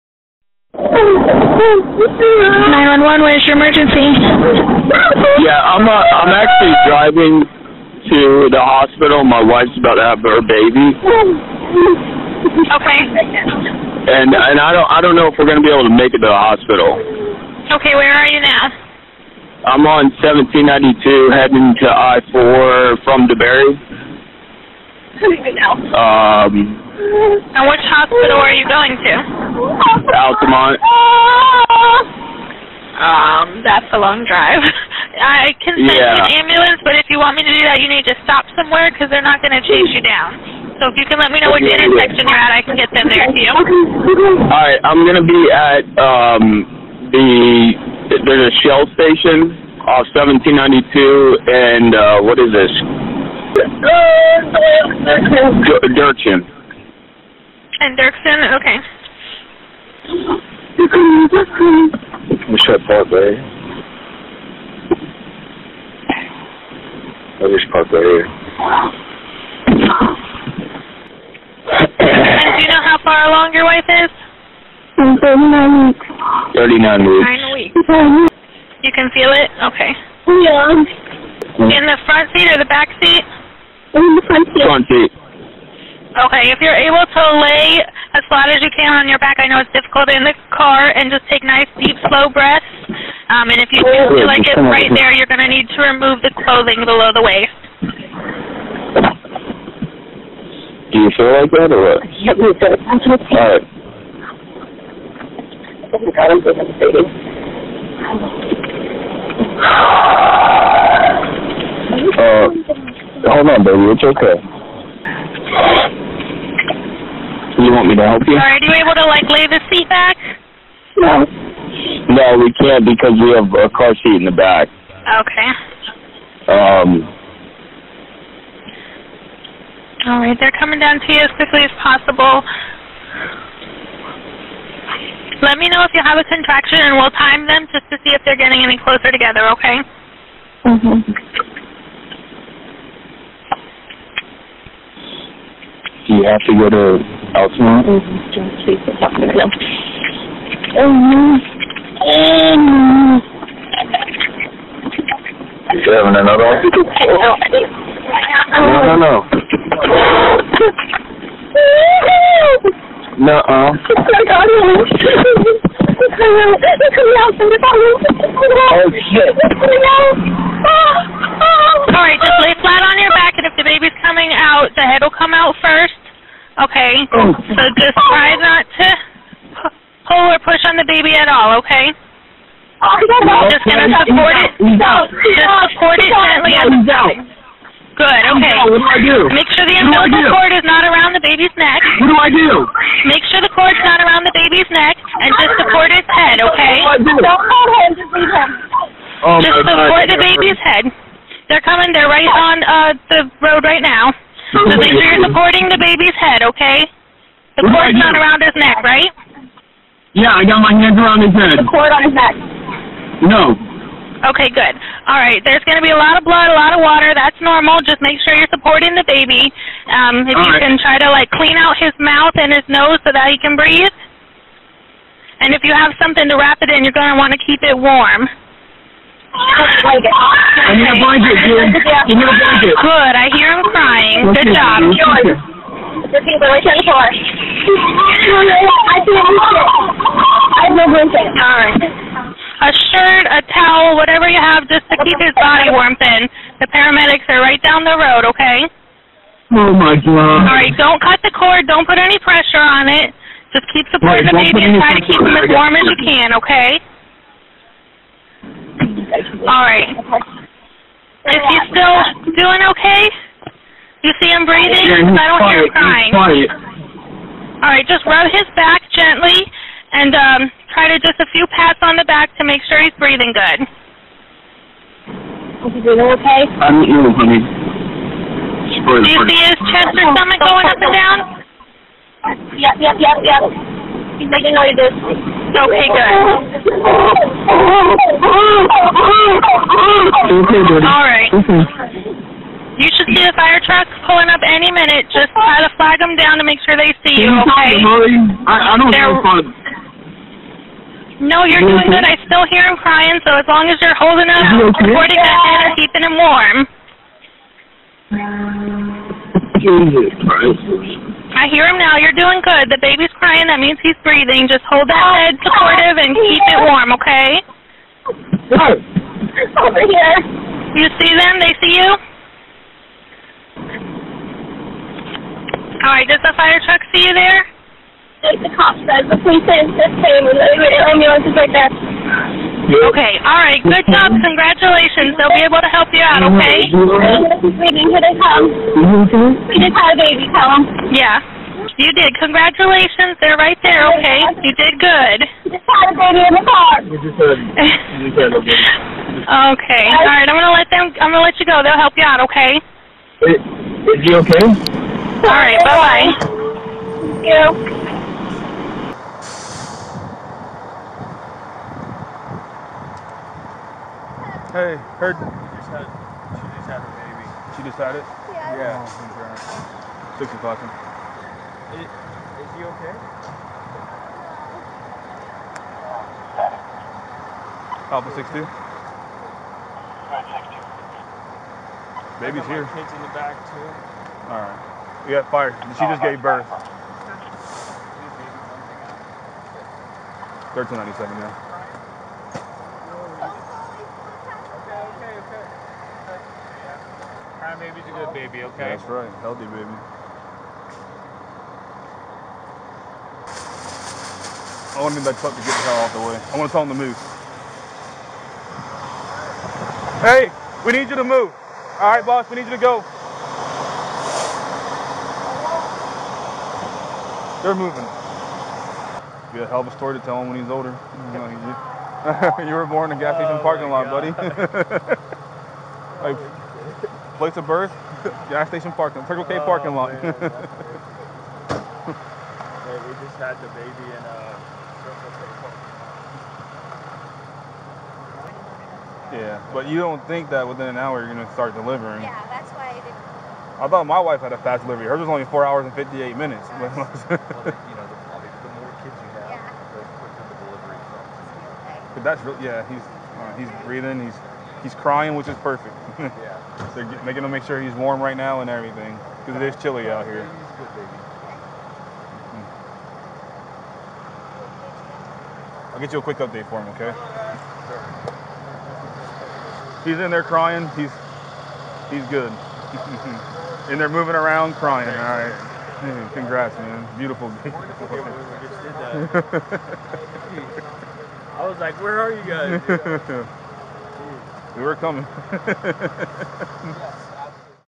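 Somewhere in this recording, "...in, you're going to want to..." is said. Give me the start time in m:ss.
3:46.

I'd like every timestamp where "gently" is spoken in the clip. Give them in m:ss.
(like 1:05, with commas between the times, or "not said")
3:06, 4:28.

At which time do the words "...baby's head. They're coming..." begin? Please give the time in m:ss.
3:20.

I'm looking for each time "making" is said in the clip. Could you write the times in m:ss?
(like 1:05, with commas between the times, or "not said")
4:44, 7:37.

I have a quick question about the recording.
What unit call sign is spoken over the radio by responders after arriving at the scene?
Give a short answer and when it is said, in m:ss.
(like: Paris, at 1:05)
Alpha 62, at 6:17.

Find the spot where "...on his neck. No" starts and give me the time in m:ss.
3:31.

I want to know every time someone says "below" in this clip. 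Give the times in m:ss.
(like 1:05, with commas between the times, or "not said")
1:36.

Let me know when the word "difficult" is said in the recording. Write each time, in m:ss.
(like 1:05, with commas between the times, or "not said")
1:29.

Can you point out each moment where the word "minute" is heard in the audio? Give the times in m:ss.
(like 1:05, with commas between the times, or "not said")
4:54, 7:26.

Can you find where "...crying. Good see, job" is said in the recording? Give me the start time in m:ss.
3:53.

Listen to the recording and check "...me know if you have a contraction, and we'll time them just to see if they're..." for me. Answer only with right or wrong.
right.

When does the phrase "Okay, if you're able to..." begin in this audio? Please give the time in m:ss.
1:26.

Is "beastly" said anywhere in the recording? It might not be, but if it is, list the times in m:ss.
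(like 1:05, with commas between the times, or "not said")
not said.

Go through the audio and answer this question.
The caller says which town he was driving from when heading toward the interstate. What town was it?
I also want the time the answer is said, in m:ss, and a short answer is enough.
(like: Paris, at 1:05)
DeBary, at 0:23.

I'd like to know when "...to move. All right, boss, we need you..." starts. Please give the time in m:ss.
6:50.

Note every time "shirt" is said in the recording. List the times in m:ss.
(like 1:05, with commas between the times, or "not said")
4:02.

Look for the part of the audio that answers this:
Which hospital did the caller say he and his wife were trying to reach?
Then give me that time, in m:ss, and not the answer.
0:30.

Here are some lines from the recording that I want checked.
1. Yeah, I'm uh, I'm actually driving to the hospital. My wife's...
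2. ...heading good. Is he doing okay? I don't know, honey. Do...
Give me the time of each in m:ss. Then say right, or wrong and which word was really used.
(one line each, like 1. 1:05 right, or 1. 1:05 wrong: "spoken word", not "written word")
1. 0:05 right
2. 4:32 wrong: "breathing", not "heading".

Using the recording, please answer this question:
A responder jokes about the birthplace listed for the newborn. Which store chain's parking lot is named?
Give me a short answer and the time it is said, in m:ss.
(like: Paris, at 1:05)
Circle K, at 7:09.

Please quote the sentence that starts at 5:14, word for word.
Just hold that oh, head supportive and keep it warm, okay?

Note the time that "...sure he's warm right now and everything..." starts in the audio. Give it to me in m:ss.
7:37.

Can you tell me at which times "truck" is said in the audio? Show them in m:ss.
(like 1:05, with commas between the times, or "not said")
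4:53, 5:26.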